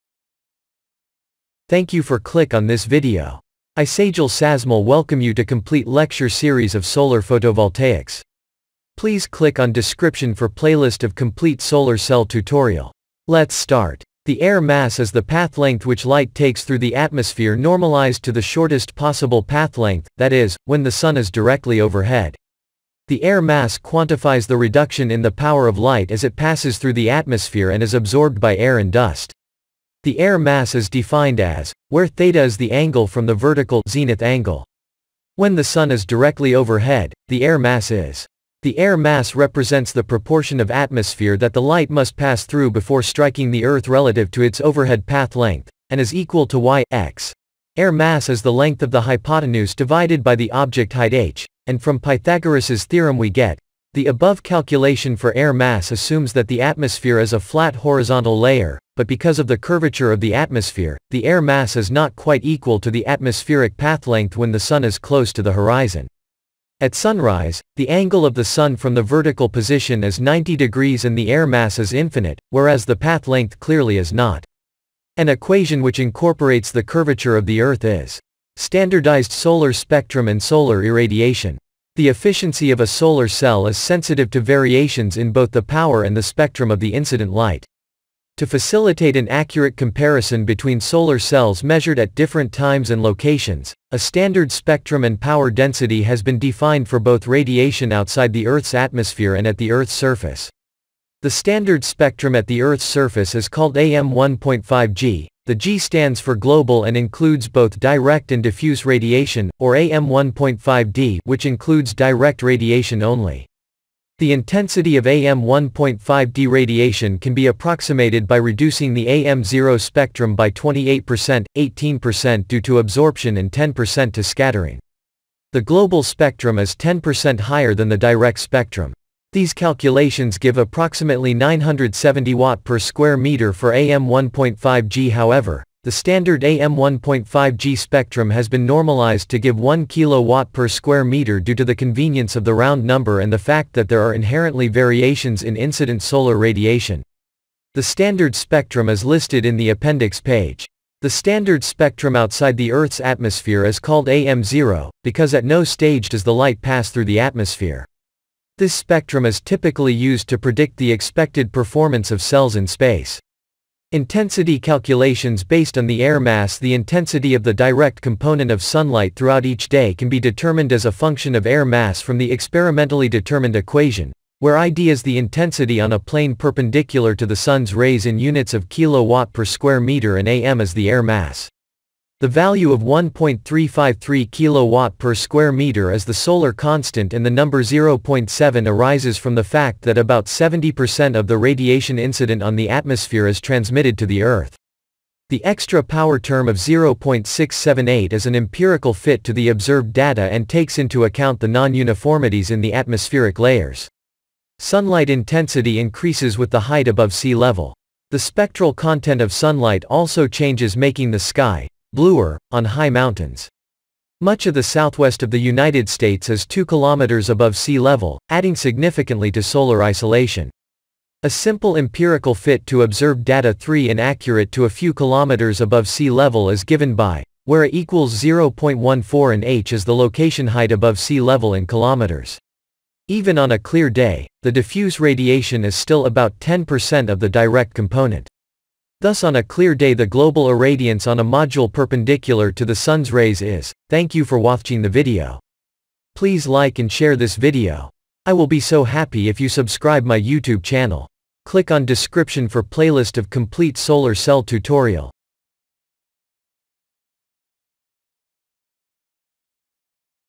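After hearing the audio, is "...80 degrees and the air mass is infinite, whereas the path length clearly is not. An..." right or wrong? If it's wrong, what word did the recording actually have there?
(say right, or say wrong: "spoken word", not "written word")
wrong: "90", not "80".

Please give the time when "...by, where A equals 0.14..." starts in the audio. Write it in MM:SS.
03:46.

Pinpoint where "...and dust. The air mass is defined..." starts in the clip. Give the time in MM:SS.
00:28.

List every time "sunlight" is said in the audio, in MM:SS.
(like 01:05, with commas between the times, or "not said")
02:48, 03:24, 03:29.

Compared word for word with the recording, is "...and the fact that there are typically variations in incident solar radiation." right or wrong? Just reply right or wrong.
wrong.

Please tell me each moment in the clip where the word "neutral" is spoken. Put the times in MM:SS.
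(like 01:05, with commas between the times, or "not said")
not said.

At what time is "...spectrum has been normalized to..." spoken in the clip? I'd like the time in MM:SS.
02:17.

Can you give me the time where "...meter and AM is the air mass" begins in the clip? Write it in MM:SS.
02:59.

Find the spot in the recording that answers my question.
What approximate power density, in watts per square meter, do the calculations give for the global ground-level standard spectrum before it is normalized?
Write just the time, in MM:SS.
02:11.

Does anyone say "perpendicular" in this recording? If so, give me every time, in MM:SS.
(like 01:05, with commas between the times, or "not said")
02:56, 04:01.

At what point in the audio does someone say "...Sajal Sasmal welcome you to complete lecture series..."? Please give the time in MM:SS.
00:03.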